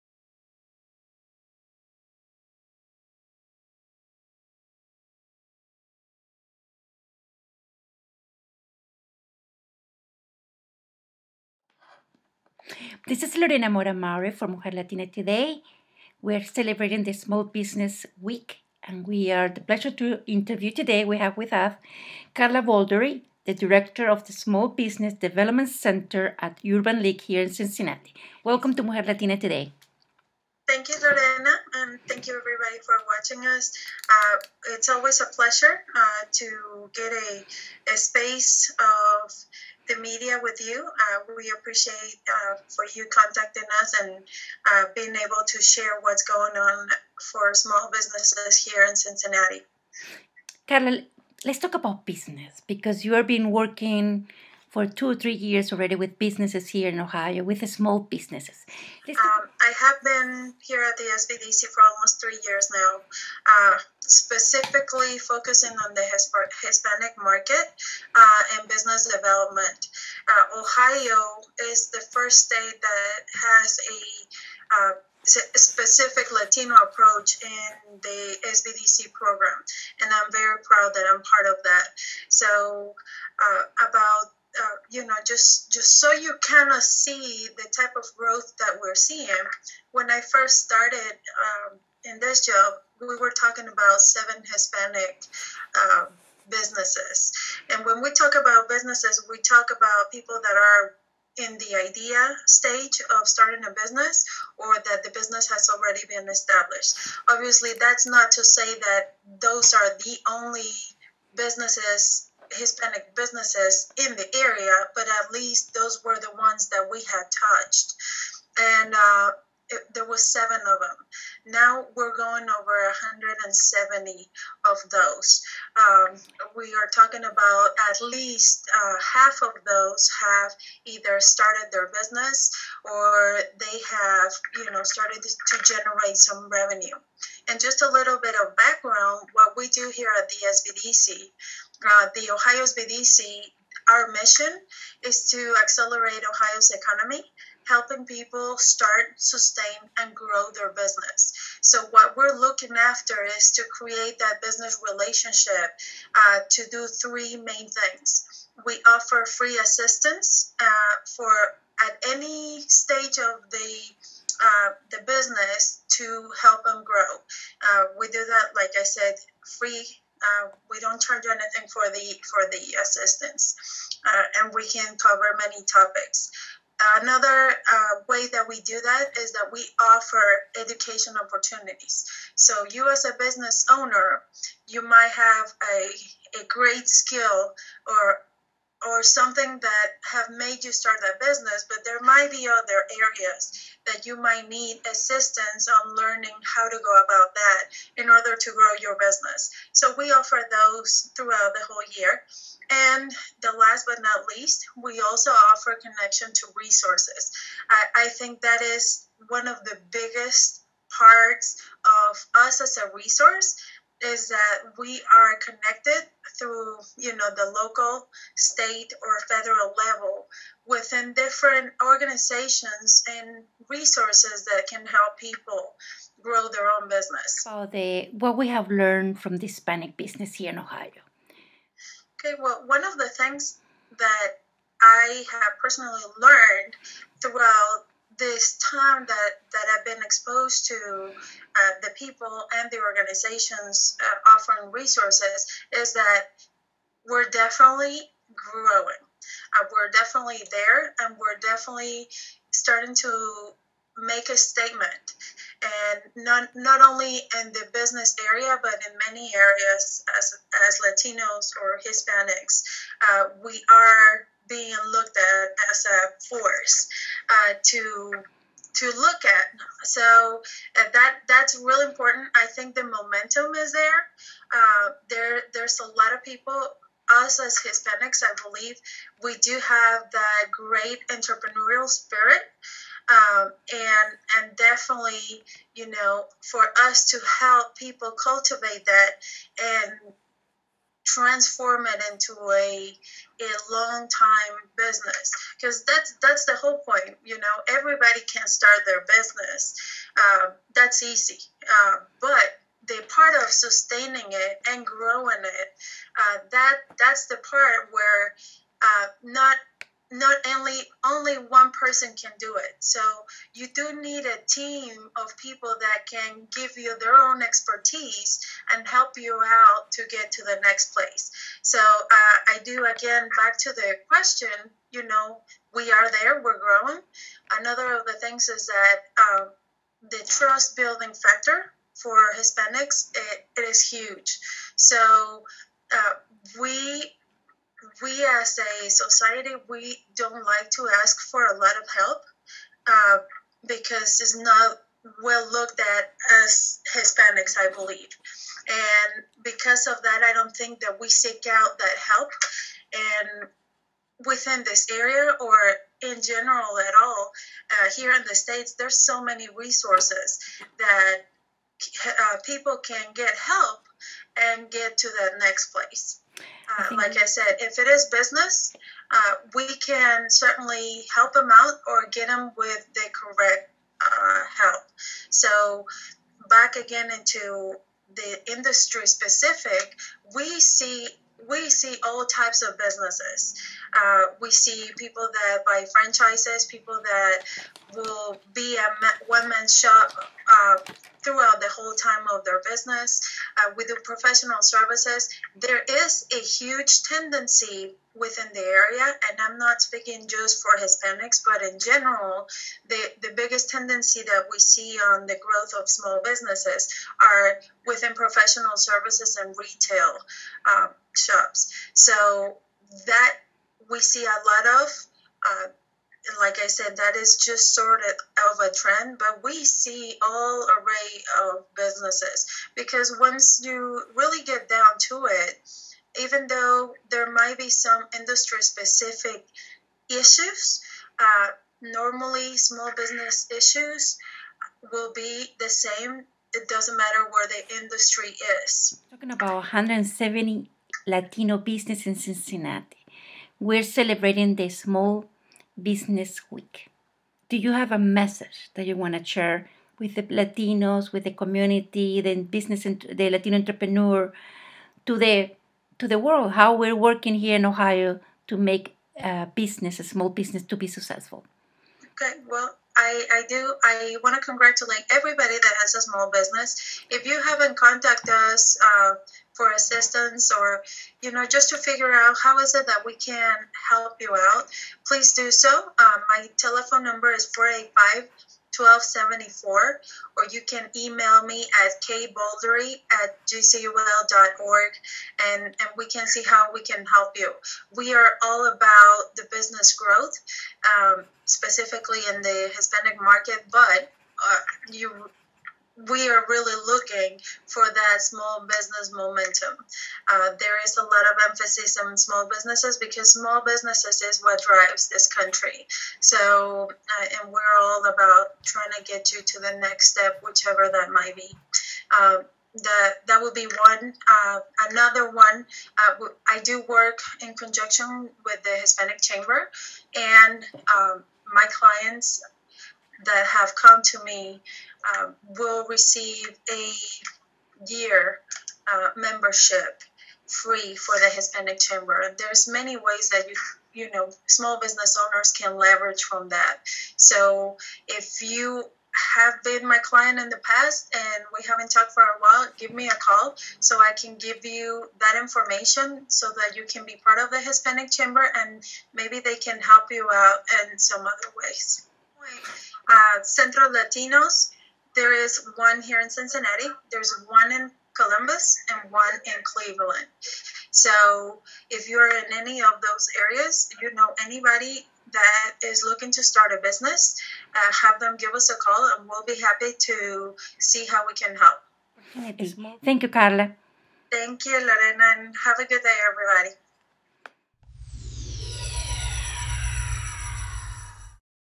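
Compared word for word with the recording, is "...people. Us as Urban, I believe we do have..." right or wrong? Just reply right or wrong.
wrong.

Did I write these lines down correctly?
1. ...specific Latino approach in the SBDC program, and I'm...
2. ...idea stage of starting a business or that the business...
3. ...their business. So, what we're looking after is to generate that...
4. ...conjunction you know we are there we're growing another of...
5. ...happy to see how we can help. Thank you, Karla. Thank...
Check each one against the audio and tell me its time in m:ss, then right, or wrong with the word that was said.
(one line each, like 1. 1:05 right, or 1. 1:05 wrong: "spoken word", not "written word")
1. 1:15 right
2. 1:41 right
3. 2:30 wrong: "create", not "generate"
4. 5:24 wrong: "question", not "conjunction"
5. 9:29 right.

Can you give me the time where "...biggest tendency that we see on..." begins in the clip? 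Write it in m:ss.
6:43.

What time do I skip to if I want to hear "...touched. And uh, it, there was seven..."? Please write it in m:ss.
1:57.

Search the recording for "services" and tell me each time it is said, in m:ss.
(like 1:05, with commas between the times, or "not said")
6:34, 6:48.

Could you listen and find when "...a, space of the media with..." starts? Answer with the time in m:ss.
0:37.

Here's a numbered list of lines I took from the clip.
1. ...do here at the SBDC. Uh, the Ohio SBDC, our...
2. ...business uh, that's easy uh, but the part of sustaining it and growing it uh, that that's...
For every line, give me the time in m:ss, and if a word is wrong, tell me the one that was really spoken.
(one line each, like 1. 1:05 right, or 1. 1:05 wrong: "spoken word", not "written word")
1. 2:19 right
2. 4:59 right.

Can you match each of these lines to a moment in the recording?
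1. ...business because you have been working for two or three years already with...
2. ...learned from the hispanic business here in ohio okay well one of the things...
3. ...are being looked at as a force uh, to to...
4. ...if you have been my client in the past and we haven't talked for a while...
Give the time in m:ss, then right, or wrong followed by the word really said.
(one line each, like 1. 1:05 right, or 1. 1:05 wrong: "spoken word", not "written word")
1. 0:52 right
2. 3:48 right
3. 4:23 right
4. 8:58 right.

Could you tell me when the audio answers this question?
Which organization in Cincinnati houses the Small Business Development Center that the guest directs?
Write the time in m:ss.
0:26.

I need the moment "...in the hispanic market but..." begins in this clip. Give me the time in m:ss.
8:12.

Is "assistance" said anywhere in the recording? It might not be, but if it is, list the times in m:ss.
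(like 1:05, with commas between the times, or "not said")
2:39, 2:52, 3:14, 7:49.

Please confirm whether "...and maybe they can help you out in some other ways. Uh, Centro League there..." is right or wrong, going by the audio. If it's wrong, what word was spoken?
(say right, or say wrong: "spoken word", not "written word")
wrong: "Latinos", not "League".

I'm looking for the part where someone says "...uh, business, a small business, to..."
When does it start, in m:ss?
7:39.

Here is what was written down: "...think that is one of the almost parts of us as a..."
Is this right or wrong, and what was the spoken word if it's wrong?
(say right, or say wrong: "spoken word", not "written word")
wrong: "biggest", not "almost".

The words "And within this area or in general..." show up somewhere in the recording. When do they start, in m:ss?
5:52.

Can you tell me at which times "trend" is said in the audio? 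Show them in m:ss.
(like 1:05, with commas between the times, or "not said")
6:58.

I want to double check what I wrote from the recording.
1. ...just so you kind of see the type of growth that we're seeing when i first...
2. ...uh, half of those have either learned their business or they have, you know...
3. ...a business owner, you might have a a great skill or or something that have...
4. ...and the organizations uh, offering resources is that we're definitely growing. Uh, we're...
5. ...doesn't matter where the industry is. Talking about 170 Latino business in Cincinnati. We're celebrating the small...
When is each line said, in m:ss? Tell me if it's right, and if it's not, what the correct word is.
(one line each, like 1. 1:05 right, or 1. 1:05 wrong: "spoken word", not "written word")
1. 1:25 right
2. 2:08 wrong: "started", not "learned"
3. 3:03 right
4. 4:02 right
5. 7:16 right.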